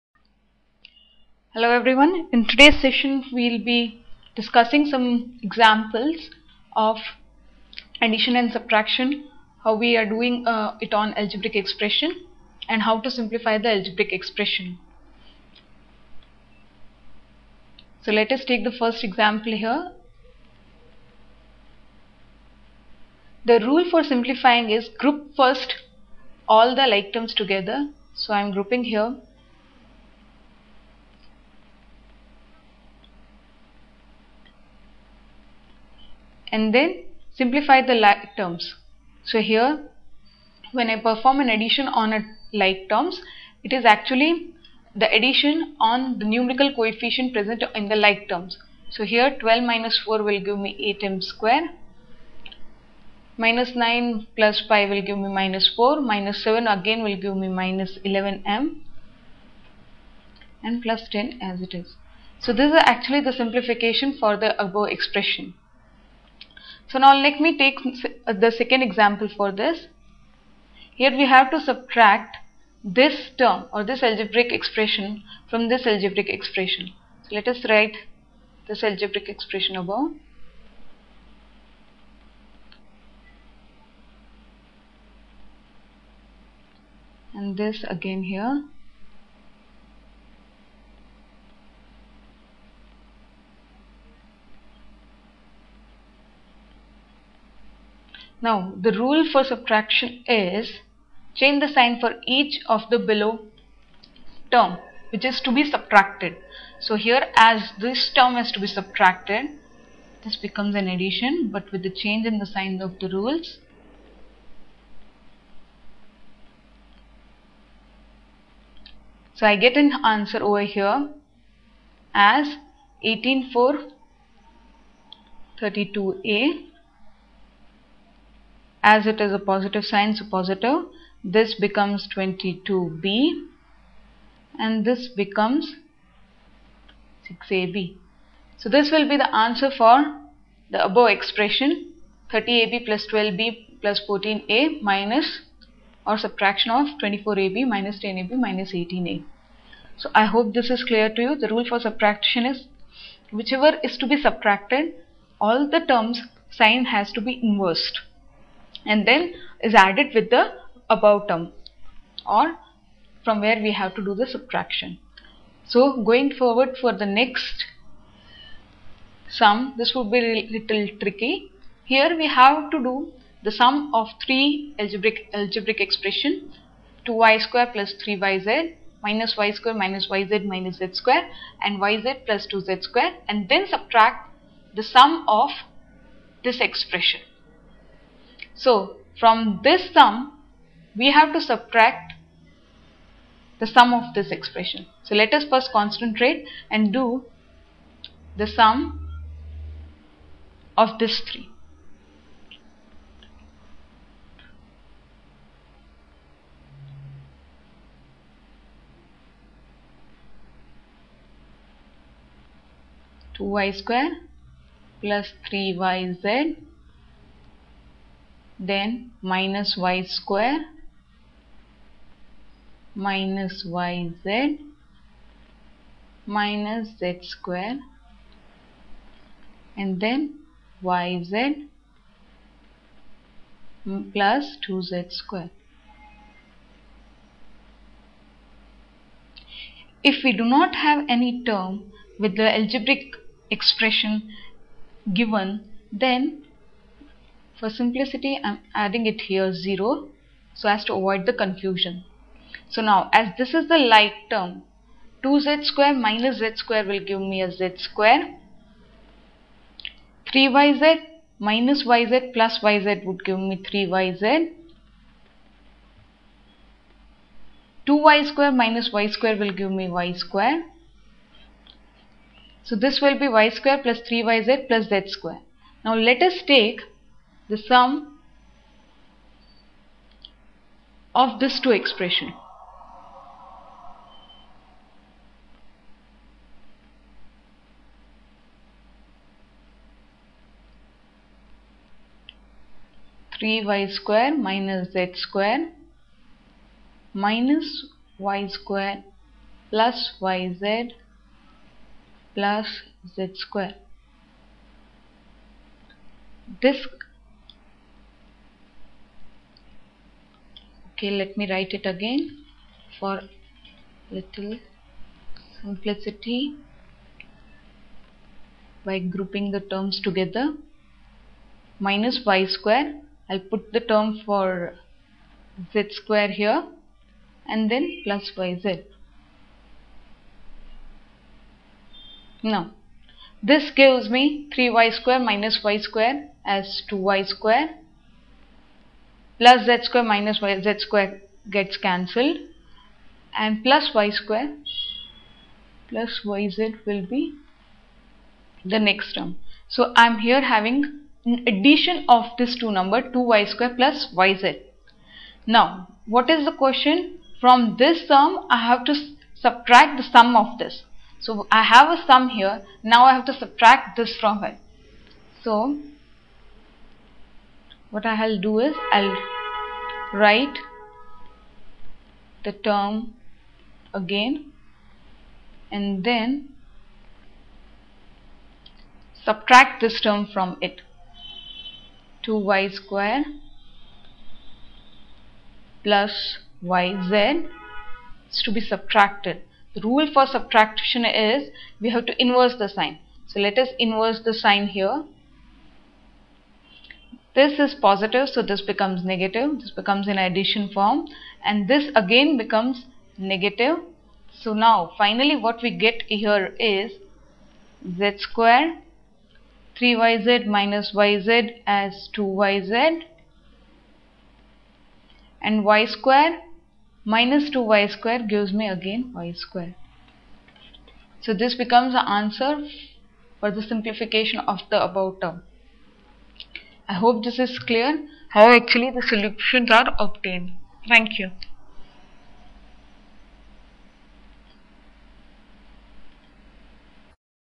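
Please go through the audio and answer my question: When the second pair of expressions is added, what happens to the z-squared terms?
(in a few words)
cancelled.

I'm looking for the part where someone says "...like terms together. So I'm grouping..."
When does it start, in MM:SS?
00:26.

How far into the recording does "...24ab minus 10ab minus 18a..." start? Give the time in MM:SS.
02:27.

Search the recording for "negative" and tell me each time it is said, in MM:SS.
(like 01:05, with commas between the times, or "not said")
06:39, 06:43.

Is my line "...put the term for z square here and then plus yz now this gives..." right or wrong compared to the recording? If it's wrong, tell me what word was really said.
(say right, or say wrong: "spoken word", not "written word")
right.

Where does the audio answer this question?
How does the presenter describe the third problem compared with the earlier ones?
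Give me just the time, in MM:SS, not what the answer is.
02:50.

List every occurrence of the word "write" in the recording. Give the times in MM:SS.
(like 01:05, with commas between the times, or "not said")
01:17, 05:11, 06:10.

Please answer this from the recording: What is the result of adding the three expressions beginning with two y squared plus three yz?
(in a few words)
y square plus 3yz plus z square.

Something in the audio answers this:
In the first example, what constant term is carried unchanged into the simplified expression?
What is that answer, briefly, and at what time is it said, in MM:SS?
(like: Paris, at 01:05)
plus 10, at 01:00.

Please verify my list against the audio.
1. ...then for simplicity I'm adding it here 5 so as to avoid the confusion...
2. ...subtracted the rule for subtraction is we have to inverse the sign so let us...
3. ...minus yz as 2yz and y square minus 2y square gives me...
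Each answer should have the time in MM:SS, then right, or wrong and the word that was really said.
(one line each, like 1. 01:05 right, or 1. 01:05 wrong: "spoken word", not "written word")
1. 04:05 wrong: "0", not "5"
2. 06:28 right
3. 06:50 right.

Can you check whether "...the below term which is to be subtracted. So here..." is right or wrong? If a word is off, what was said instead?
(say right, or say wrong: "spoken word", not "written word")
right.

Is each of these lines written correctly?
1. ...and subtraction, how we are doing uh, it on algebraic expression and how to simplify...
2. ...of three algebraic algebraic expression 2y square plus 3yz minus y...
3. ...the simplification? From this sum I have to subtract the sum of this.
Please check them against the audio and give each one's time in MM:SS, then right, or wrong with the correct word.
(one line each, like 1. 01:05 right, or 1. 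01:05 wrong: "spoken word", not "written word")
1. 00:08 right
2. 02:53 right
3. 05:56 wrong: "question", not "simplification".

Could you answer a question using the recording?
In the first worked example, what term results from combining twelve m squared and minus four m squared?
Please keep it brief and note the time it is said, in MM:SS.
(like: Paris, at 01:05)
8m square, at 00:50.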